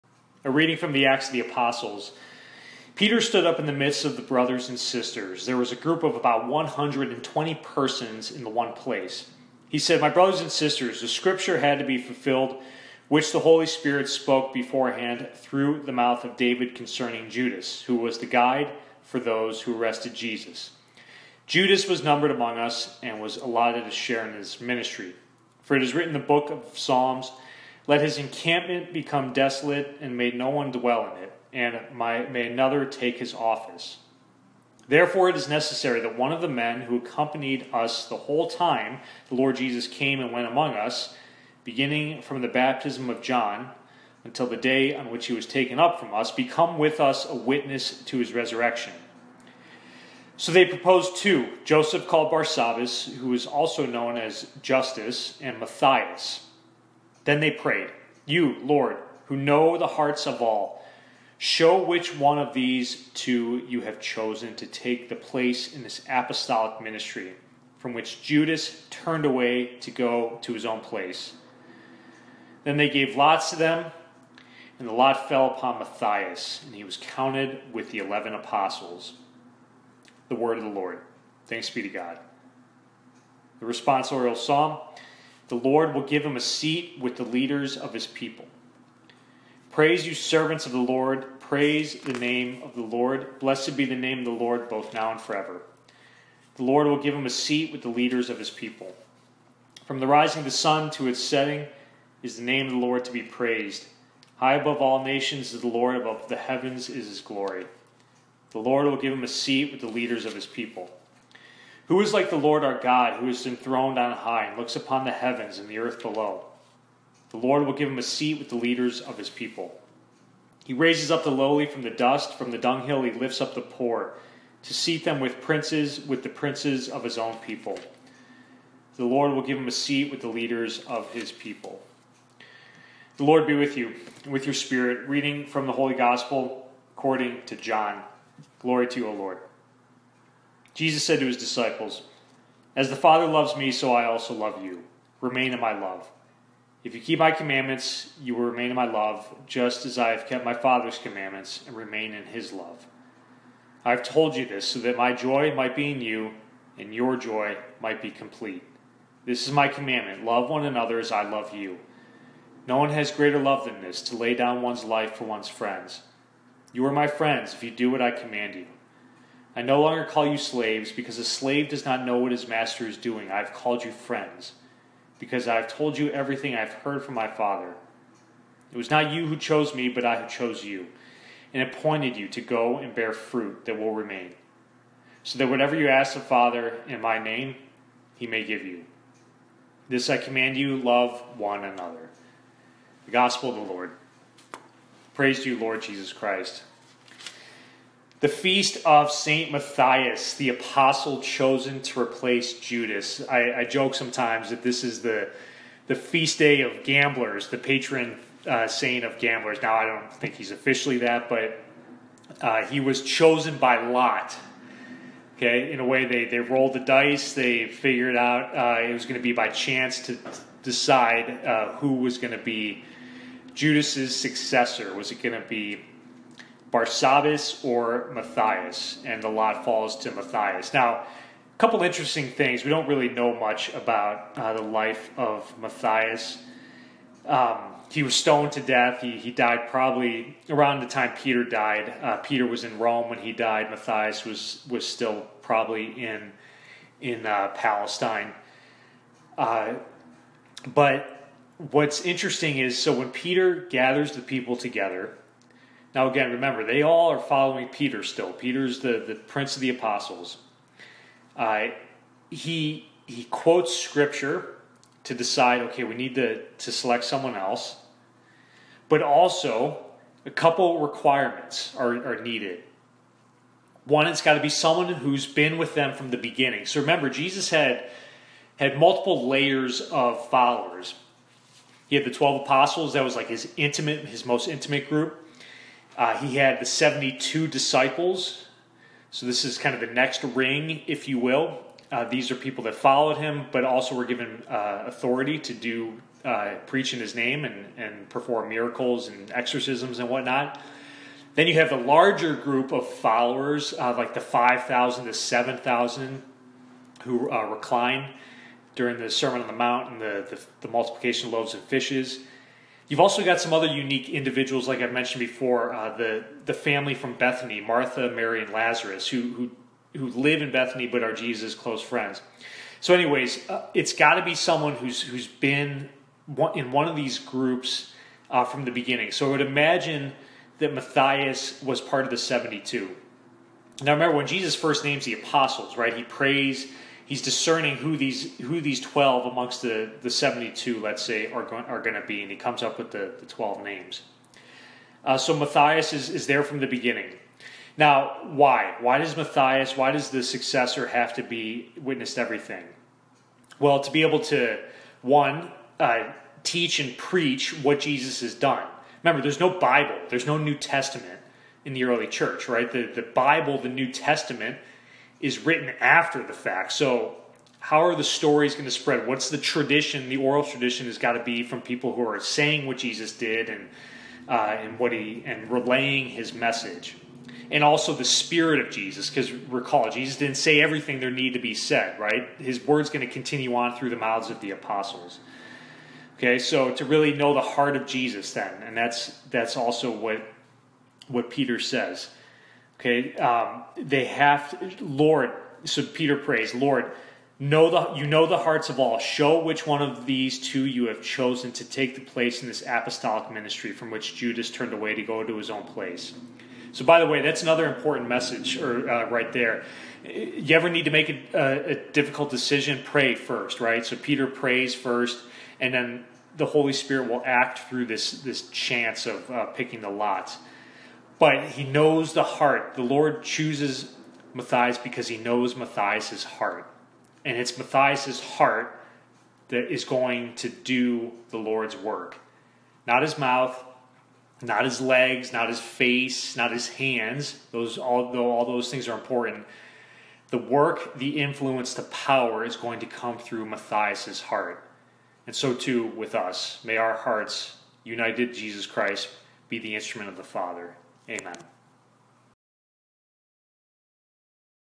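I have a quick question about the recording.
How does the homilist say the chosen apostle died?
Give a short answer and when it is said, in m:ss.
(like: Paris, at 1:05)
stoned to death, at 3:58.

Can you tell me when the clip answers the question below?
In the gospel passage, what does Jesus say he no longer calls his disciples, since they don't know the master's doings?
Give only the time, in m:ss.
2:50.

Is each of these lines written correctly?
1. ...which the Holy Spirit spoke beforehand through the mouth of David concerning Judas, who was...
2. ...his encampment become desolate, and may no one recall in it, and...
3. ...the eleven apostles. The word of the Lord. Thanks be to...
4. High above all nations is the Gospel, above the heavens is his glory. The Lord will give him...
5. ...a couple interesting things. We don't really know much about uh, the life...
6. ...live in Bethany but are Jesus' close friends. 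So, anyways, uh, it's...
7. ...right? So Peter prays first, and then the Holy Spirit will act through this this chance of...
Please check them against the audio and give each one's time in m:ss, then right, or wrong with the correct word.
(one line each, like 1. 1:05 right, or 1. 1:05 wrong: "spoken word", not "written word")
1. 0:13 right
2. 0:28 wrong: "dwell", not "recall"
3. 1:17 right
4. 1:44 wrong: "Lord", not "Gospel"
5. 3:50 right
6. 5:20 right
7. 6:53 right.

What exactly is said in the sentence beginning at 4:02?
Uh, Peter was in Rome when he died.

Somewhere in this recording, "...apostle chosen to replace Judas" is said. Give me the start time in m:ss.
3:20.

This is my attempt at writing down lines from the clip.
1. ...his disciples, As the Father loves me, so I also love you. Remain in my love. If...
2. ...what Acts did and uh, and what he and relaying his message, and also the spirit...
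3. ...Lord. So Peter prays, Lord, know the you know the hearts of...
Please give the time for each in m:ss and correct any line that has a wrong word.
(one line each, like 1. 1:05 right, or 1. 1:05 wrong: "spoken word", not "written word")
1. 2:21 right
2. 6:12 wrong: "Jesus", not "Acts"
3. 6:34 right.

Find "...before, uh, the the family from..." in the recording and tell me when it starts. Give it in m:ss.
5:15.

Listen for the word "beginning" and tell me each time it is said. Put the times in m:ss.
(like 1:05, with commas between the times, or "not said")
0:41, 4:36, 5:28, 5:46.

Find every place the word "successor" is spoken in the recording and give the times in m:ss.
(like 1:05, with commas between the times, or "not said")
3:44, 5:50.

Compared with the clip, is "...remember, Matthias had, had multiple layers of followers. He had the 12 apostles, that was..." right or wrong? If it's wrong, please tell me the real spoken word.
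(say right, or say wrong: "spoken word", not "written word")
wrong: "Jesus", not "Matthias".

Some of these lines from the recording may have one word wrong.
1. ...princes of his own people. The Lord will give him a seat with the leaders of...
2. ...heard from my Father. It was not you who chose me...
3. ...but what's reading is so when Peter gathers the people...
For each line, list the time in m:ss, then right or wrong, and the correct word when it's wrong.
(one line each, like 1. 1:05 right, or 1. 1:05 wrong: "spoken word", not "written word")
1. 2:06 right
2. 2:56 right
3. 4:10 wrong: "interesting", not "reading".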